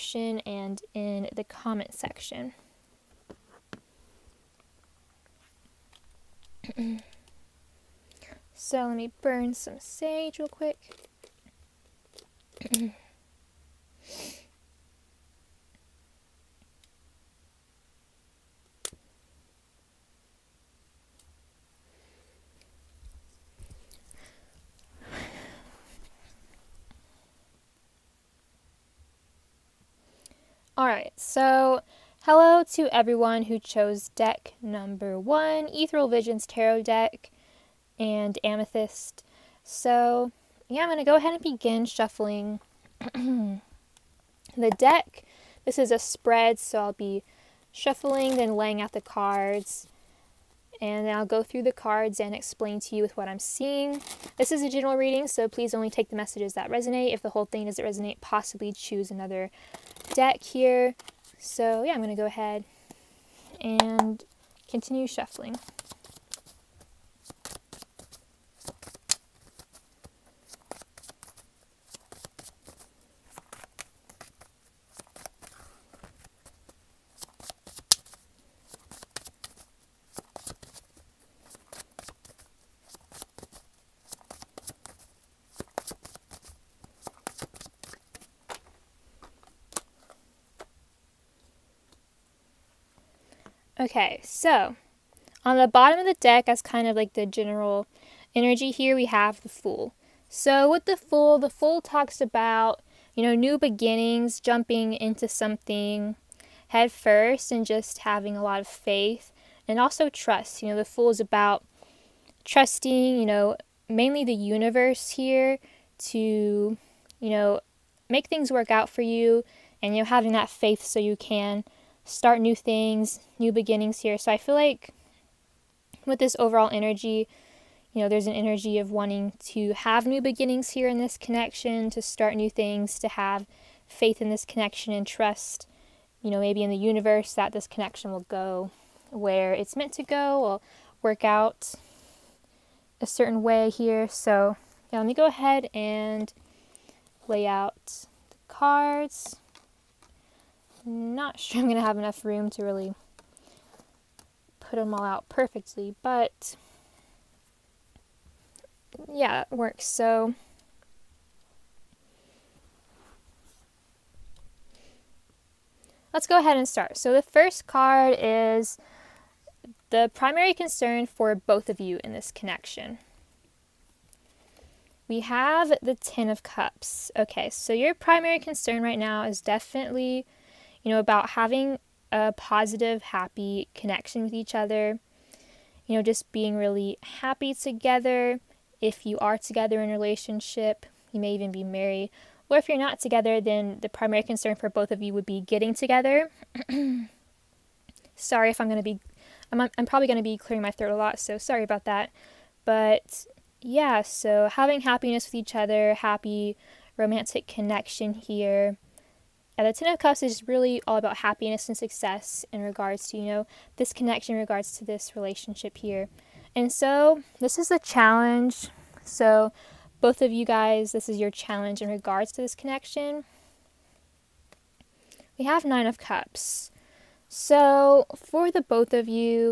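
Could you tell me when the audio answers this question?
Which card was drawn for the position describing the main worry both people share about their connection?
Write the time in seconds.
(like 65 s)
175 s.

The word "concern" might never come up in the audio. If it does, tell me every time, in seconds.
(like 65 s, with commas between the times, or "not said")
170 s, 178 s, 194 s.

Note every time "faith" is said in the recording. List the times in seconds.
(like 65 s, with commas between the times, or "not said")
108 s, 120 s, 133 s.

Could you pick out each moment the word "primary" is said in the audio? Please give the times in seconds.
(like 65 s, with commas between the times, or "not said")
170 s, 177 s, 193 s.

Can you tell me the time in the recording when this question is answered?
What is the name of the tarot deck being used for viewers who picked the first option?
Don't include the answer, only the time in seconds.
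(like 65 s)
35 s.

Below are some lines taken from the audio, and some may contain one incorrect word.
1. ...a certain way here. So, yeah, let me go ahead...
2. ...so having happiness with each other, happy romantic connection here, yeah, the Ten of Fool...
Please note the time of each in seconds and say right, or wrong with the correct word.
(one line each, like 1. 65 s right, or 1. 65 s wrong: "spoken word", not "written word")
1. 142 s right
2. 204 s wrong: "Cups", not "Fool".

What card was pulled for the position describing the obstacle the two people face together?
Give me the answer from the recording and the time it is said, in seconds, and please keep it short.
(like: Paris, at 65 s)
Nine of Cups, at 225 s.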